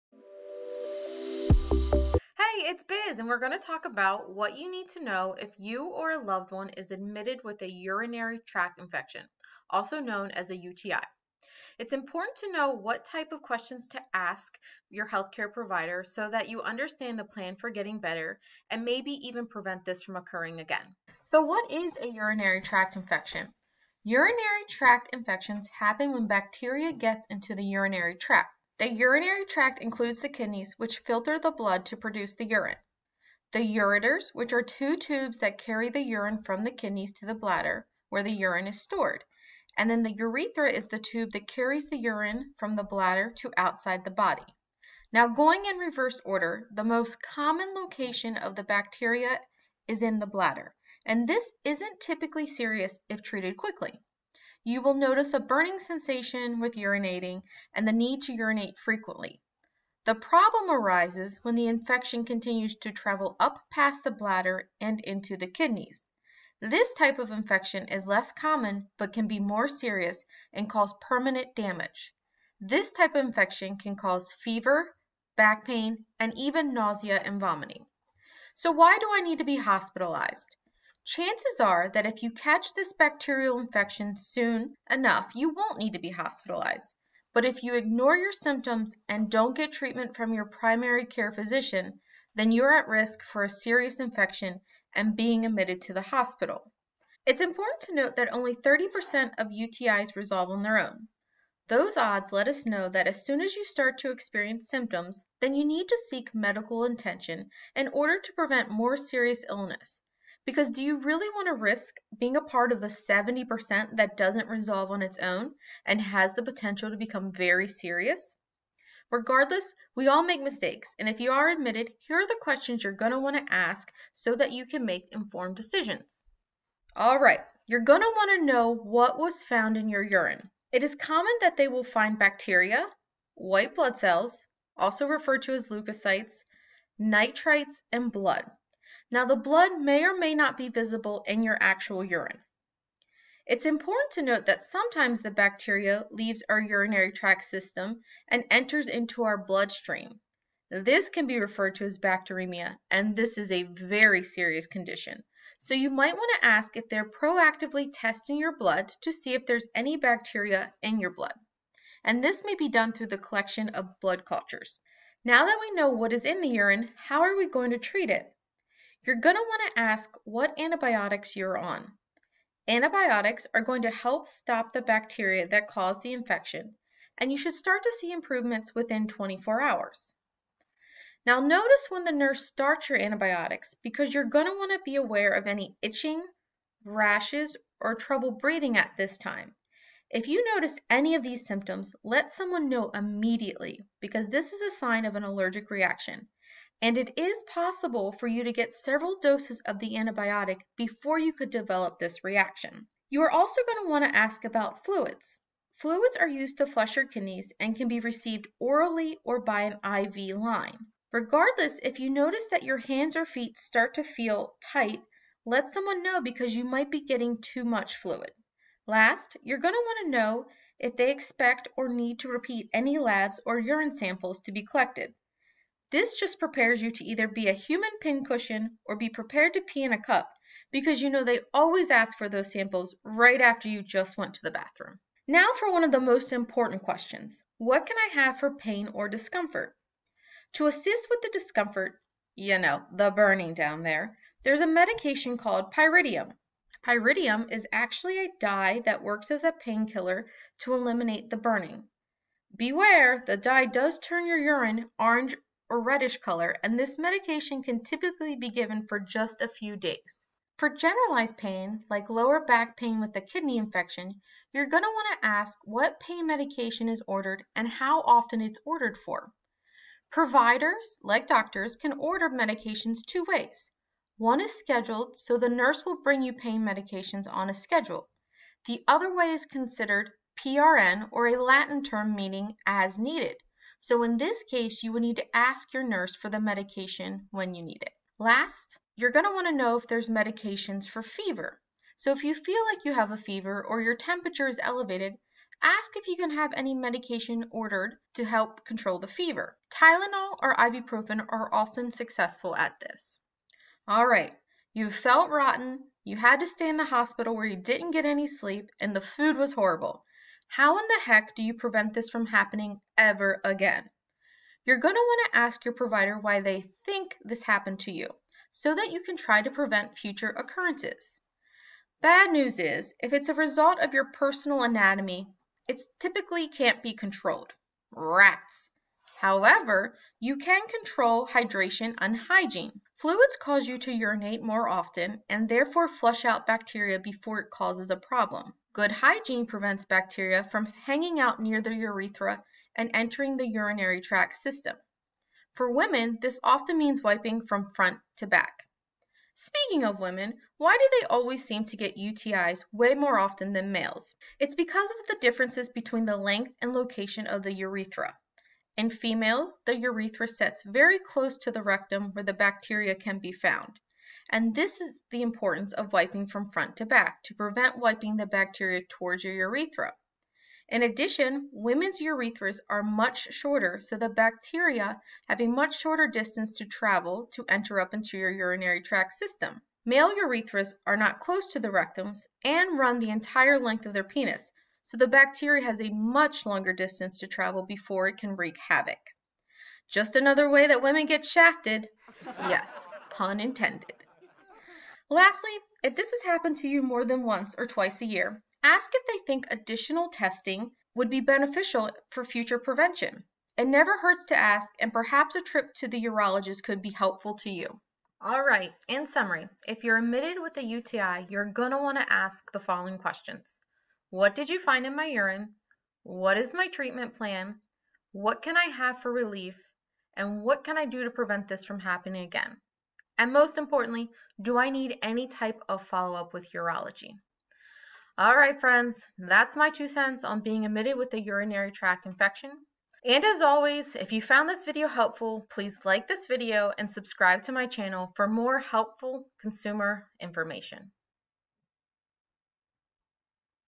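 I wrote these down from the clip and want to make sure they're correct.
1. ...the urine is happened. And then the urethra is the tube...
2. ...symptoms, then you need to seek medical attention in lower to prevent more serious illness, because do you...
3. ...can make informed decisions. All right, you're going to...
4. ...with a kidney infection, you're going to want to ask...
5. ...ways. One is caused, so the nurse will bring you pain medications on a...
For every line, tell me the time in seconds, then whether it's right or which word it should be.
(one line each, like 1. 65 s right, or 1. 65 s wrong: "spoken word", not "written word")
1. 38 s wrong: "stored", not "happened"
2. 104 s wrong: "order", not "lower"
3. 124 s right
4. 262 s right
5. 273 s wrong: "scheduled", not "caused".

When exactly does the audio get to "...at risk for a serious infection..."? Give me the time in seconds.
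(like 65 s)
92 s.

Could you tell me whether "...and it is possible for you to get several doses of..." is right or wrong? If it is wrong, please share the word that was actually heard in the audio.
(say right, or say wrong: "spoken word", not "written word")
right.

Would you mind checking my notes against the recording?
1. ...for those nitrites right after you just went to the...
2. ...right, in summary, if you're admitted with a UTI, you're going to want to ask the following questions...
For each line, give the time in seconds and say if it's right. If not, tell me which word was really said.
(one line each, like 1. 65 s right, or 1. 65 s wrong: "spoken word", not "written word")
1. 232 s wrong: "samples", not "nitrites"
2. 408 s right.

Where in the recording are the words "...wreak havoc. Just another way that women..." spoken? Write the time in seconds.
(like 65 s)
388 s.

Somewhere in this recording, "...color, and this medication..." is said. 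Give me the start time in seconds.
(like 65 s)
256 s.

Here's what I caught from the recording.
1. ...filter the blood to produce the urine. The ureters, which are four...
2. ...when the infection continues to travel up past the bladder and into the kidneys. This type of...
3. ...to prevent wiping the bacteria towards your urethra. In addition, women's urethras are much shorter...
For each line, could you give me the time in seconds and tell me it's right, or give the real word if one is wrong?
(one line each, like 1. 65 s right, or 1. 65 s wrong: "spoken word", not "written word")
1. 31 s wrong: "two", not "four"
2. 61 s right
3. 367 s right.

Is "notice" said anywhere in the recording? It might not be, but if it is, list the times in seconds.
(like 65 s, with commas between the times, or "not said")
54 s, 181 s, 190 s, 212 s.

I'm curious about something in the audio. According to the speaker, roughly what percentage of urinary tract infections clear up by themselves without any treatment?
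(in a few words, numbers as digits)
30%.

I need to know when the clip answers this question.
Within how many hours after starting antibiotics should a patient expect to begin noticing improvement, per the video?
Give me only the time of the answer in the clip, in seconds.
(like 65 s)
179 s.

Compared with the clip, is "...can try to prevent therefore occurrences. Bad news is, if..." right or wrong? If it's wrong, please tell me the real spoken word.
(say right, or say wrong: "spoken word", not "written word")
wrong: "future", not "therefore".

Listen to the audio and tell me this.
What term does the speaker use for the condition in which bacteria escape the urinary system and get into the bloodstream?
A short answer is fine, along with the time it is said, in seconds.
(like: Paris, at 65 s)
bacteremia, at 151 s.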